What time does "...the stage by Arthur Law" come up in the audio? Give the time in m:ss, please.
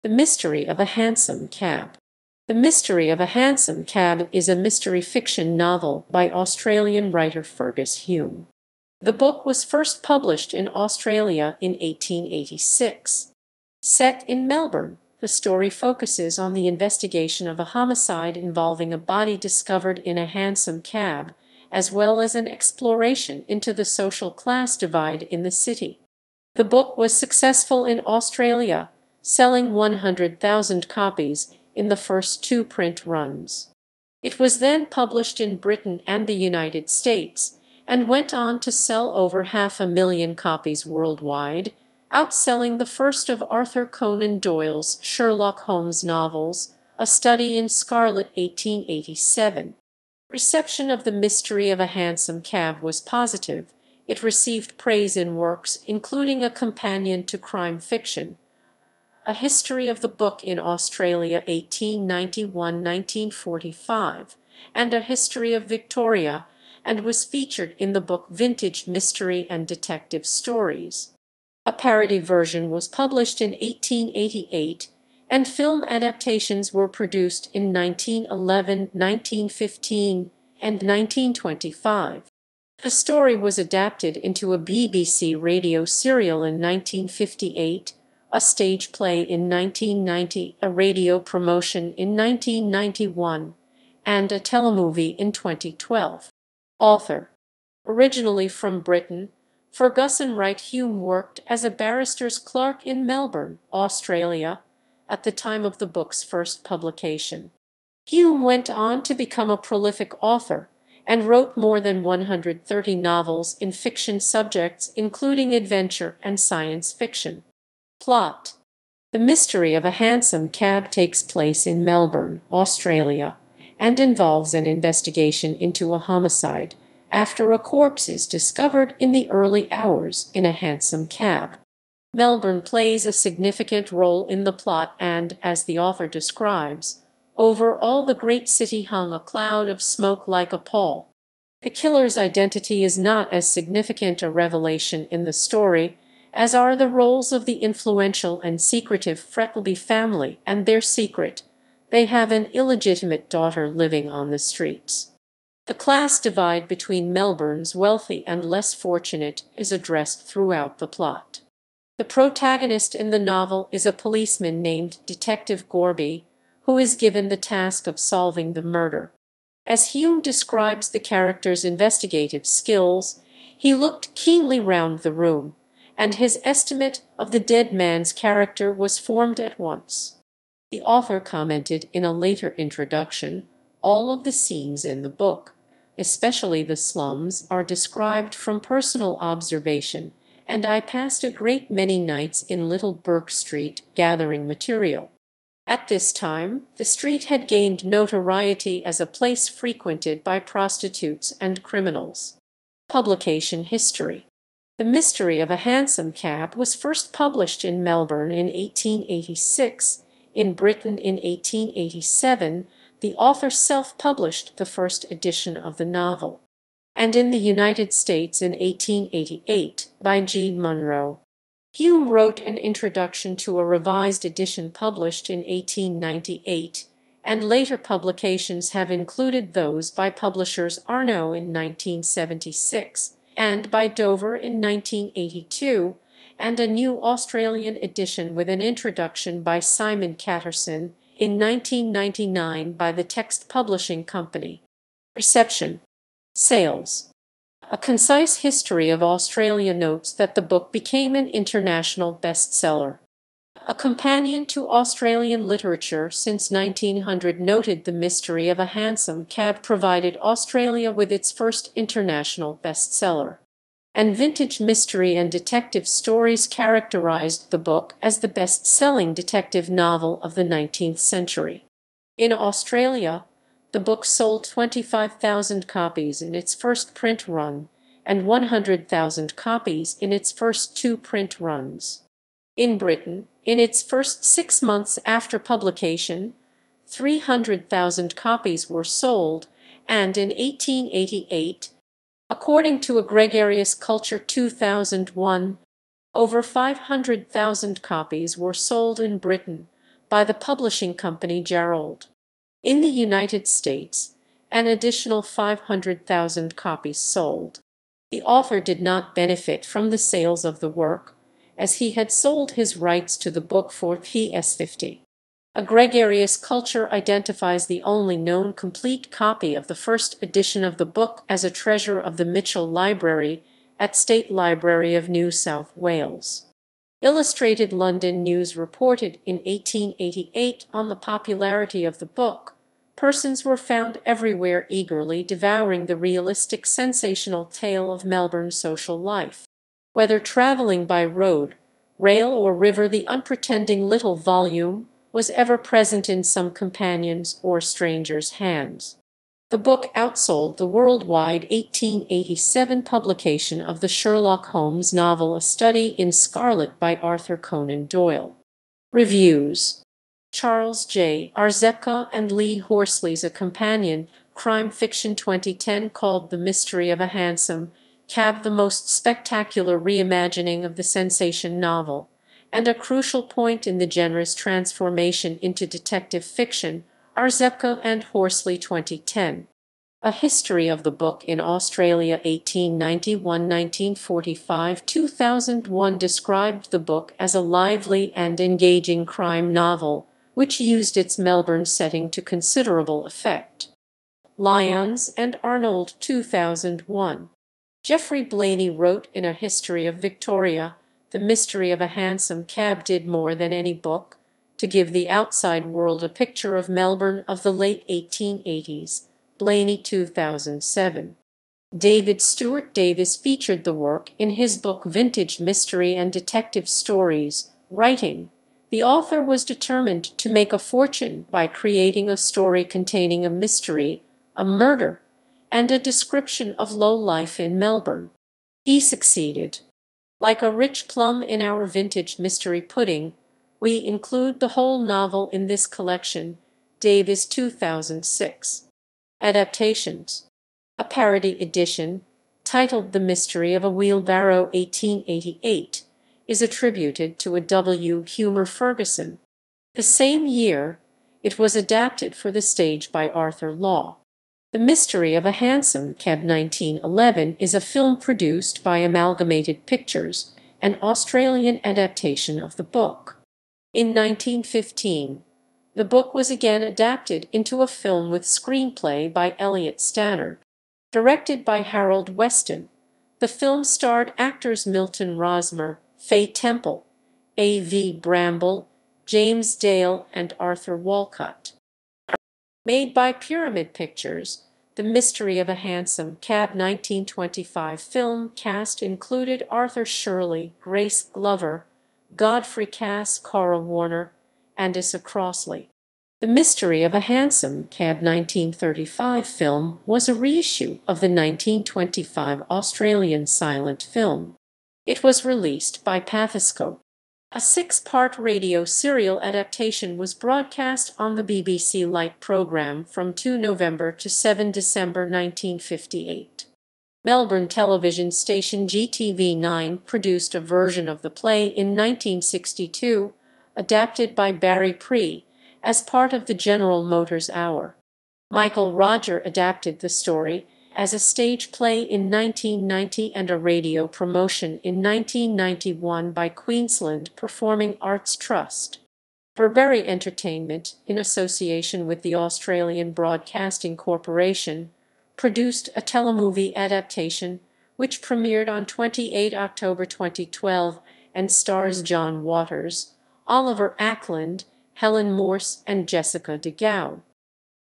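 7:32.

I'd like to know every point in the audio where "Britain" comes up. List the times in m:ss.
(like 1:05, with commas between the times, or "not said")
0:35, 1:38, 3:30, 4:42, 4:59.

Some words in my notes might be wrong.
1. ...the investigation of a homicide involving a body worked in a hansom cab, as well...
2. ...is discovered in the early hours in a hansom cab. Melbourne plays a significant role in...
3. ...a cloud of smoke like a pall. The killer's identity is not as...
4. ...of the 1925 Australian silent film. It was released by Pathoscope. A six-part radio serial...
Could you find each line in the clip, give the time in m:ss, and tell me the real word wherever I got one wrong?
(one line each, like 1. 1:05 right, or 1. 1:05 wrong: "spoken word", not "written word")
1. 0:16 wrong: "discovered", not "worked"
2. 2:08 right
3. 2:19 right
4. 8:20 right.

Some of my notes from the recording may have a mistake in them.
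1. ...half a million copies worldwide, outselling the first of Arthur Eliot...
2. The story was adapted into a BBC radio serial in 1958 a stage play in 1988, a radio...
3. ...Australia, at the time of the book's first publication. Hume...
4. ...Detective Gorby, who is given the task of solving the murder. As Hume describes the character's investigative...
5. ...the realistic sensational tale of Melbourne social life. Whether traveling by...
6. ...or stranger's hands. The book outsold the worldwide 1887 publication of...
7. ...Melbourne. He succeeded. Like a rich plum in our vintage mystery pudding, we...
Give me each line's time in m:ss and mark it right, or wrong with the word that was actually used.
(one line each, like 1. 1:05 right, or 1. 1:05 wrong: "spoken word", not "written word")
1. 0:39 wrong: "Conan", not "Eliot"
2. 1:22 wrong: "1990", not "1988"
3. 1:43 right
4. 2:45 right
5. 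5:35 right
6. 5:47 right
7. 7:07 right.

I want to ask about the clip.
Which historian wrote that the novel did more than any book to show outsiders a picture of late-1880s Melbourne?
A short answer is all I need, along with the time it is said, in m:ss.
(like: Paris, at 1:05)
Geoffrey Blainey, at 6:37.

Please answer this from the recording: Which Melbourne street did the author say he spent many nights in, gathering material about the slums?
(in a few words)
Little Burke Street.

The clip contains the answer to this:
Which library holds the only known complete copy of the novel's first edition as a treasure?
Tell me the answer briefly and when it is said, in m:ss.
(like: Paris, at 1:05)
Mitchell Library, at 5:22.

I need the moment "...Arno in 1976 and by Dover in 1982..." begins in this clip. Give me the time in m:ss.
3:50.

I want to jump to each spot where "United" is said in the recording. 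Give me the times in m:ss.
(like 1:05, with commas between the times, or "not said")
0:36, 3:37, 5:02.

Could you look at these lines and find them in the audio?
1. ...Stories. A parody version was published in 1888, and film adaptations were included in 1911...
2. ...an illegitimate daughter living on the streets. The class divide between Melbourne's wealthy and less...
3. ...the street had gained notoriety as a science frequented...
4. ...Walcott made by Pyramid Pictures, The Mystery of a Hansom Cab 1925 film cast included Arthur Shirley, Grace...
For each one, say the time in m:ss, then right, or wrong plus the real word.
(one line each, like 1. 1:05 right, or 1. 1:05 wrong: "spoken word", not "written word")
1. 1:10 wrong: "produced", not "included"
2. 2:32 right
3. 3:16 wrong: "place", not "science"
4. 8:00 right.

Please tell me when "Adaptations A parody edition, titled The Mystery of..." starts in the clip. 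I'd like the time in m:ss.
7:19.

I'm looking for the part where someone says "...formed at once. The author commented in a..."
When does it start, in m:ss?
2:58.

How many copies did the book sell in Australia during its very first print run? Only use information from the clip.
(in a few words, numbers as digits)
25,000.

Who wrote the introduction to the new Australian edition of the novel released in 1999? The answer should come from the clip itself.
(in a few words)
Simon Caterson.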